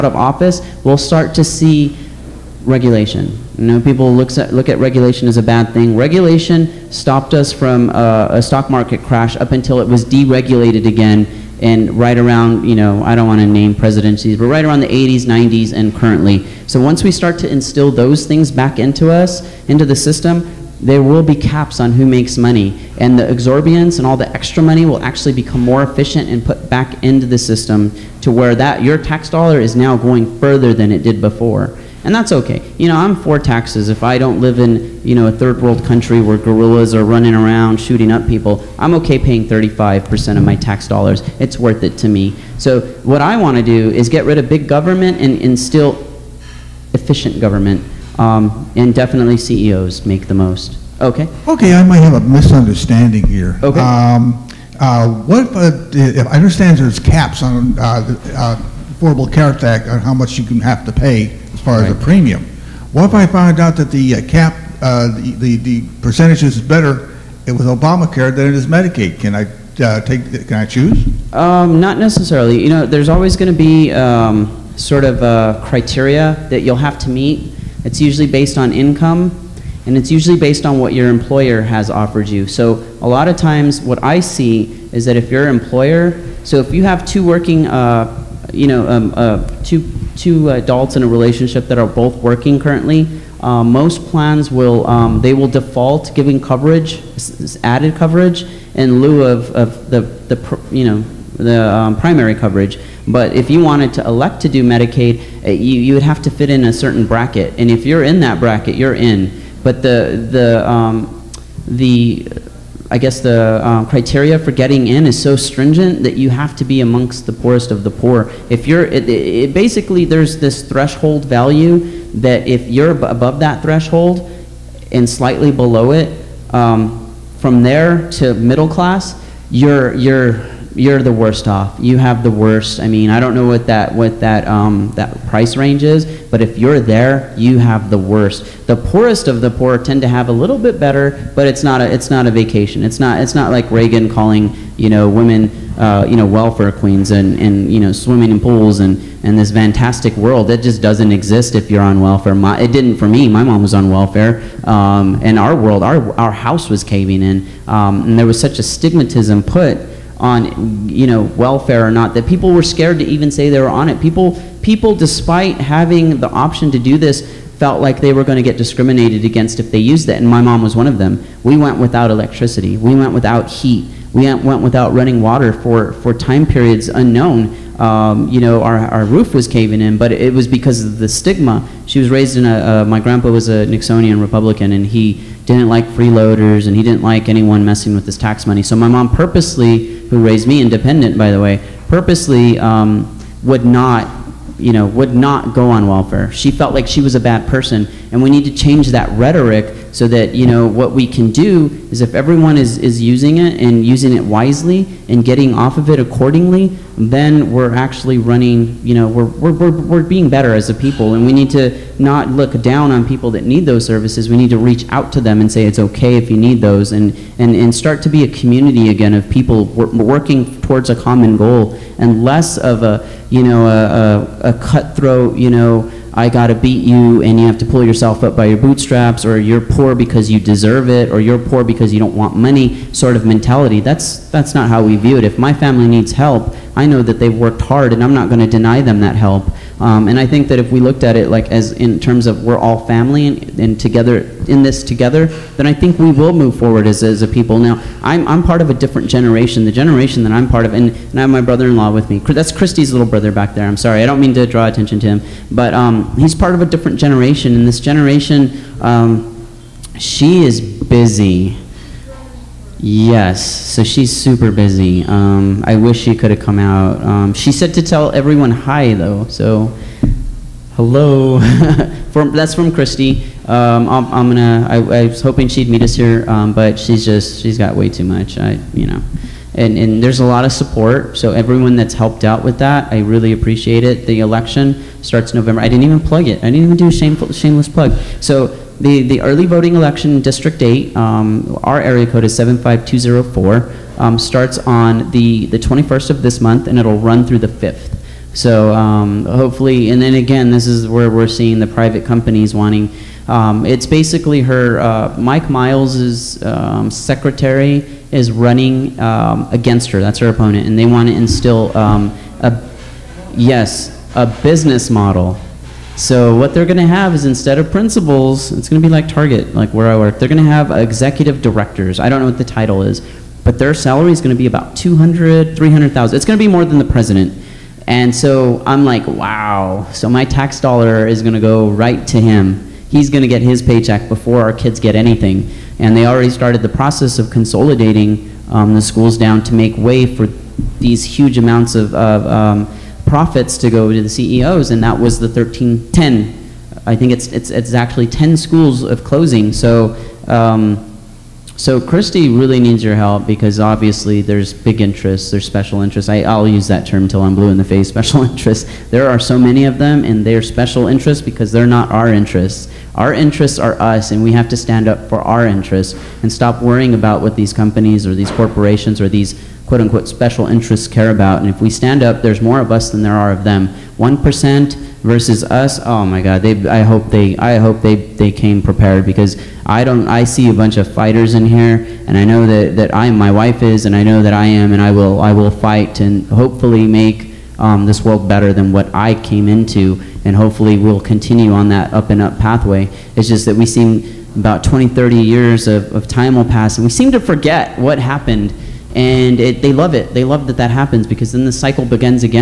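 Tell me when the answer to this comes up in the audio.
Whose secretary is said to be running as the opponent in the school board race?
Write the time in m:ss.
5:05.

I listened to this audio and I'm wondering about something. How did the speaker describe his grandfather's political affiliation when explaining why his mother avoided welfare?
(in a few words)
Nixonian Republican.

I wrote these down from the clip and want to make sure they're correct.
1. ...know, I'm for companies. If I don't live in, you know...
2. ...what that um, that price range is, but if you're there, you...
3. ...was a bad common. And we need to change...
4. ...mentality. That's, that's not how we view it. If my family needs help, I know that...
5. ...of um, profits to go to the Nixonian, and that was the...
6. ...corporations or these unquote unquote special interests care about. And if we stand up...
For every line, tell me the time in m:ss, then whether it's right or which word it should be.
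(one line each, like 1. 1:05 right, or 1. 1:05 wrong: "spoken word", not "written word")
1. 0:32 wrong: "taxes", not "companies"
2. 2:13 right
3. 3:17 wrong: "person", not "common"
4. 3:53 right
5. 5:41 wrong: "CEOs", not "Nixonian"
6. 6:08 wrong: "quote", not "unquote".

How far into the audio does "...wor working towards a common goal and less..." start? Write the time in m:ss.
3:39.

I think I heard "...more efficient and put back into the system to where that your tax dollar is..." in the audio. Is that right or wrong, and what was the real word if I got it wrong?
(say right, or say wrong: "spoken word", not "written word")
right.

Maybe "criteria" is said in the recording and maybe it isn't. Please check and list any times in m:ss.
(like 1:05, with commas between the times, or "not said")
1:15, 1:53.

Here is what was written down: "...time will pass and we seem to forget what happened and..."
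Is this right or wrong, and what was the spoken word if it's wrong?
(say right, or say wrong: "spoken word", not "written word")
right.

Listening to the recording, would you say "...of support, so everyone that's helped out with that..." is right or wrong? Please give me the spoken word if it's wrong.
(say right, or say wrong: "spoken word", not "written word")
right.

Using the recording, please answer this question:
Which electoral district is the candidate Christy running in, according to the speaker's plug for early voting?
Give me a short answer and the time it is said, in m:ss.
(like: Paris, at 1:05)
District 8, at 4:50.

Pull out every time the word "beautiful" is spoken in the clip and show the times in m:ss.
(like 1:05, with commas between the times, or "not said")
not said.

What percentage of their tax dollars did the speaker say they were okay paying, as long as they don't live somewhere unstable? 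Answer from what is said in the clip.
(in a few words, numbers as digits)
35%.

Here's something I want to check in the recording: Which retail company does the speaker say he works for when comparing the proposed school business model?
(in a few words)
Target.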